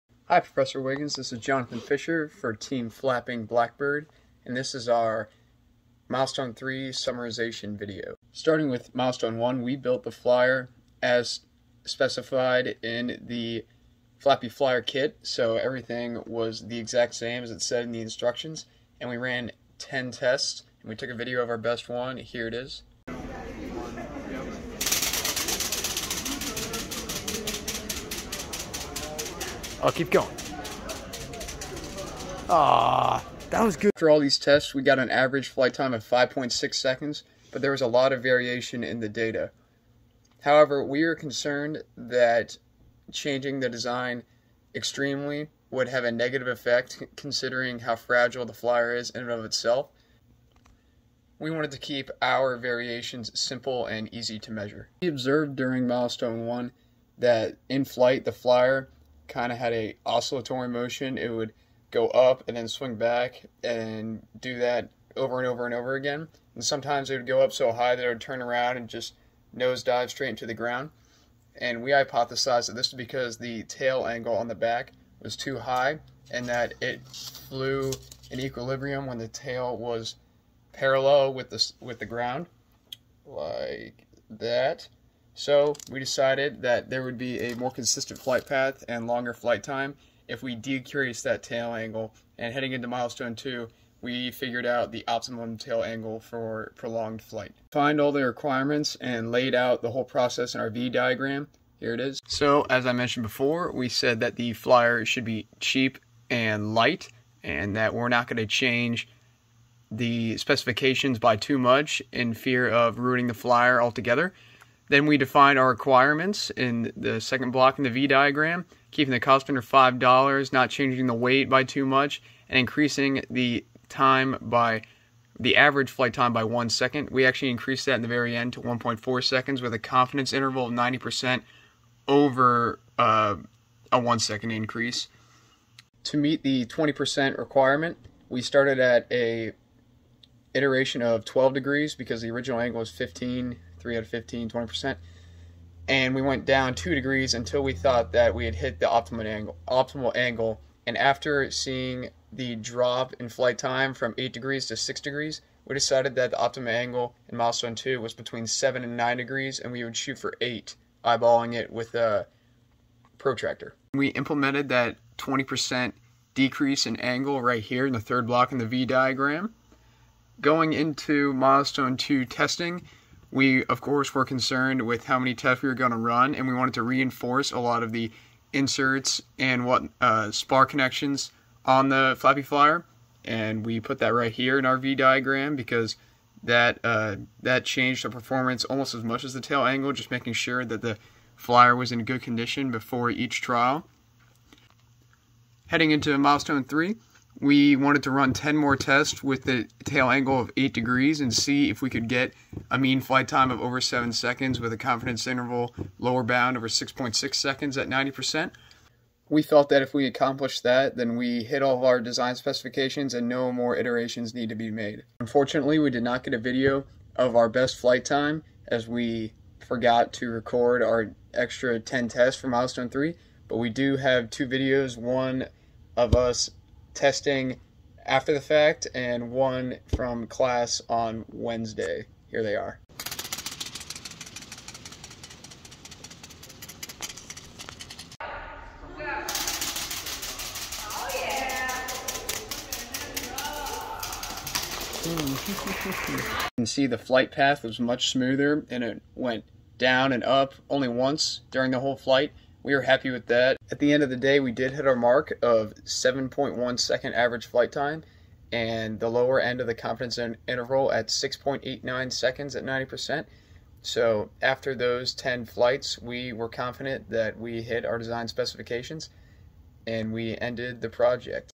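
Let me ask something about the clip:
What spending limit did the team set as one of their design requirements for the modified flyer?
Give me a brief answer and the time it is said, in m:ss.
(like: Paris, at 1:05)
$5, at 1:59.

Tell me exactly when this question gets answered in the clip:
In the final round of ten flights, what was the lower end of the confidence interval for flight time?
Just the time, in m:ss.
4:21.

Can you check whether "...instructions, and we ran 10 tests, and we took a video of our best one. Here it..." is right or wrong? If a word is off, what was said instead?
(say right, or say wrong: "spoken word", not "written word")
right.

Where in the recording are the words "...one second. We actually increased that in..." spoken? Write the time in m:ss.
2:06.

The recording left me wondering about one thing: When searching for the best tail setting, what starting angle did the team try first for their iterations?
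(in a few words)
12 degrees.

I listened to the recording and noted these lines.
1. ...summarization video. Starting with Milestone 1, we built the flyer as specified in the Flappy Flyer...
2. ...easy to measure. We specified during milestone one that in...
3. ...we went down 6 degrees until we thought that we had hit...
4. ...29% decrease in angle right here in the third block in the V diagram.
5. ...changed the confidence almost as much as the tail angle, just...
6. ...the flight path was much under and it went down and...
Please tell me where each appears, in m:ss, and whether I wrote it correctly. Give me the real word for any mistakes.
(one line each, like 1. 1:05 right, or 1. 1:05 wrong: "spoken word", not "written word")
1. 0:06 right
2. 0:54 wrong: "observed", not "specified"
3. 2:26 wrong: "2", not "6"
4. 2:45 wrong: "20", not "29"
5. 3:07 wrong: "performance", not "confidence"
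6. 4:06 wrong: "smoother", not "under".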